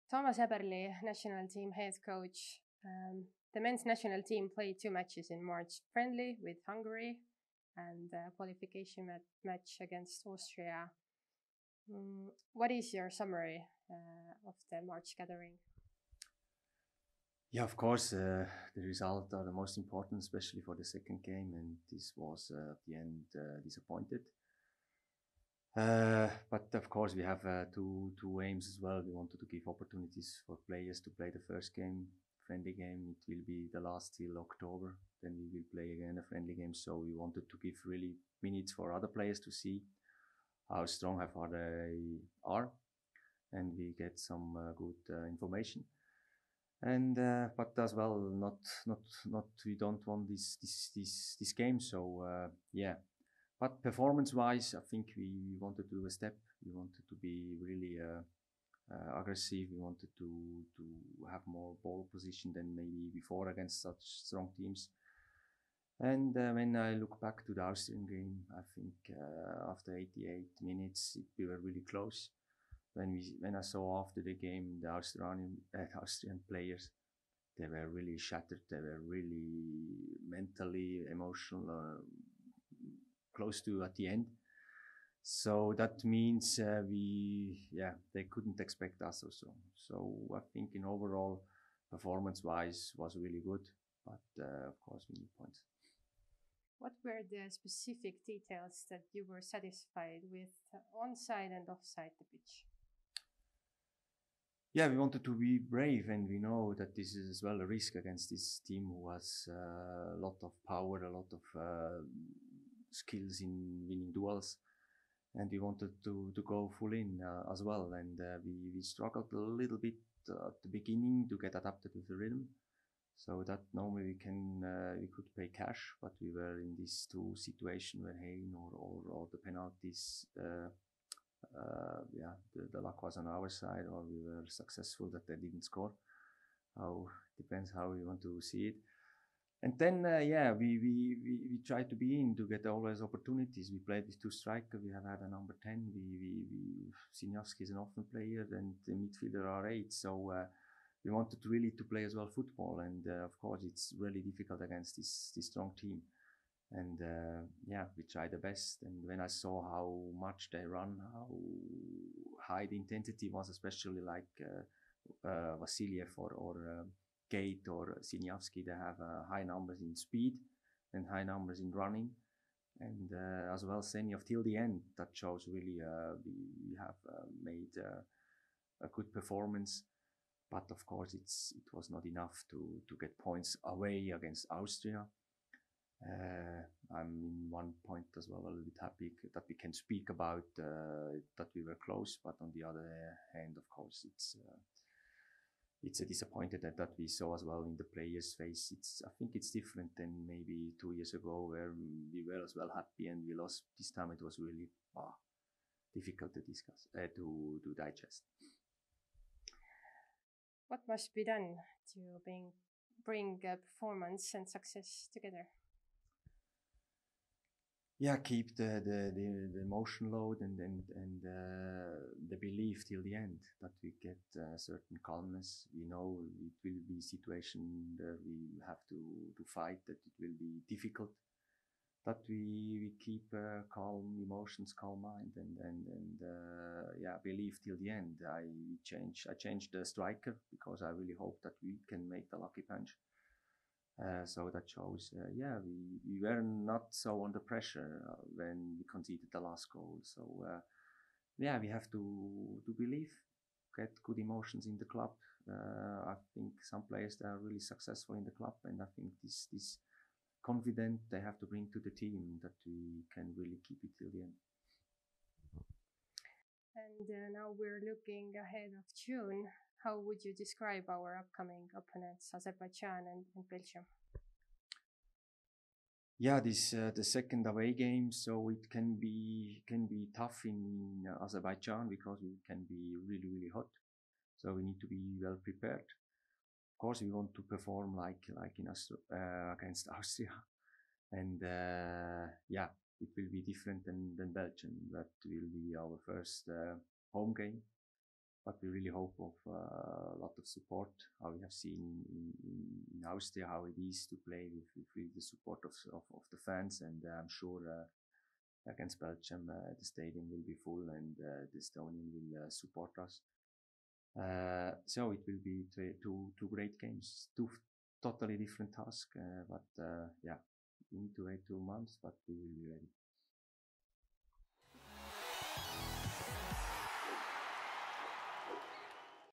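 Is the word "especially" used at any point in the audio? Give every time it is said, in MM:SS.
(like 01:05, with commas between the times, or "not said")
00:20, 02:43.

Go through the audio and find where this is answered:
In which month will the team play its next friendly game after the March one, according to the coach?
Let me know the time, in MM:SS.
00:34.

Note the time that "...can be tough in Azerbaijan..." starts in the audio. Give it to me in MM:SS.
04:39.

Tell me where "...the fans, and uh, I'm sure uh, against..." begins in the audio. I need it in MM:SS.
05:06.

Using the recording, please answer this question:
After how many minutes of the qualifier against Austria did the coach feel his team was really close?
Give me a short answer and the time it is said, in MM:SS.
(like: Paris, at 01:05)
88, at 01:09.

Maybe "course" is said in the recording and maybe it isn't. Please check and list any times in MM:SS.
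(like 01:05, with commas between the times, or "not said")
00:17, 00:26, 01:34, 02:33, 03:00, 03:13, 04:46.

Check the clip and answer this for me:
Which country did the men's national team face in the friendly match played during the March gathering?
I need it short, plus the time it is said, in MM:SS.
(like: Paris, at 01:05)
Hungary, at 00:06.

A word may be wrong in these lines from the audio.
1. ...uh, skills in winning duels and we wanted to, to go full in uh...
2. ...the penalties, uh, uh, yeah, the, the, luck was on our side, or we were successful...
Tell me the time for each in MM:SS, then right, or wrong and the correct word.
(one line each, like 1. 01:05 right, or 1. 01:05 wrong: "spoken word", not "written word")
1. 01:51 right
2. 02:09 right.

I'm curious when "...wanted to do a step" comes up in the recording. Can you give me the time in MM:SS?
00:55.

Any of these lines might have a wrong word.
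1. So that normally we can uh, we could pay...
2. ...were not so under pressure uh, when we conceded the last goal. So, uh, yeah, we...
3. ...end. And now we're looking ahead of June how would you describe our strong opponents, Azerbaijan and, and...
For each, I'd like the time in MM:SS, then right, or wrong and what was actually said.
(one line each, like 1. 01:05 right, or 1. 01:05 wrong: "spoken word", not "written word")
1. 02:03 right
2. 04:06 right
3. 04:24 wrong: "upcoming", not "strong".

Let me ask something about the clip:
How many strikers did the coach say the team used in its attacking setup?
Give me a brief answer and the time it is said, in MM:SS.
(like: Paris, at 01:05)
2, at 02:24.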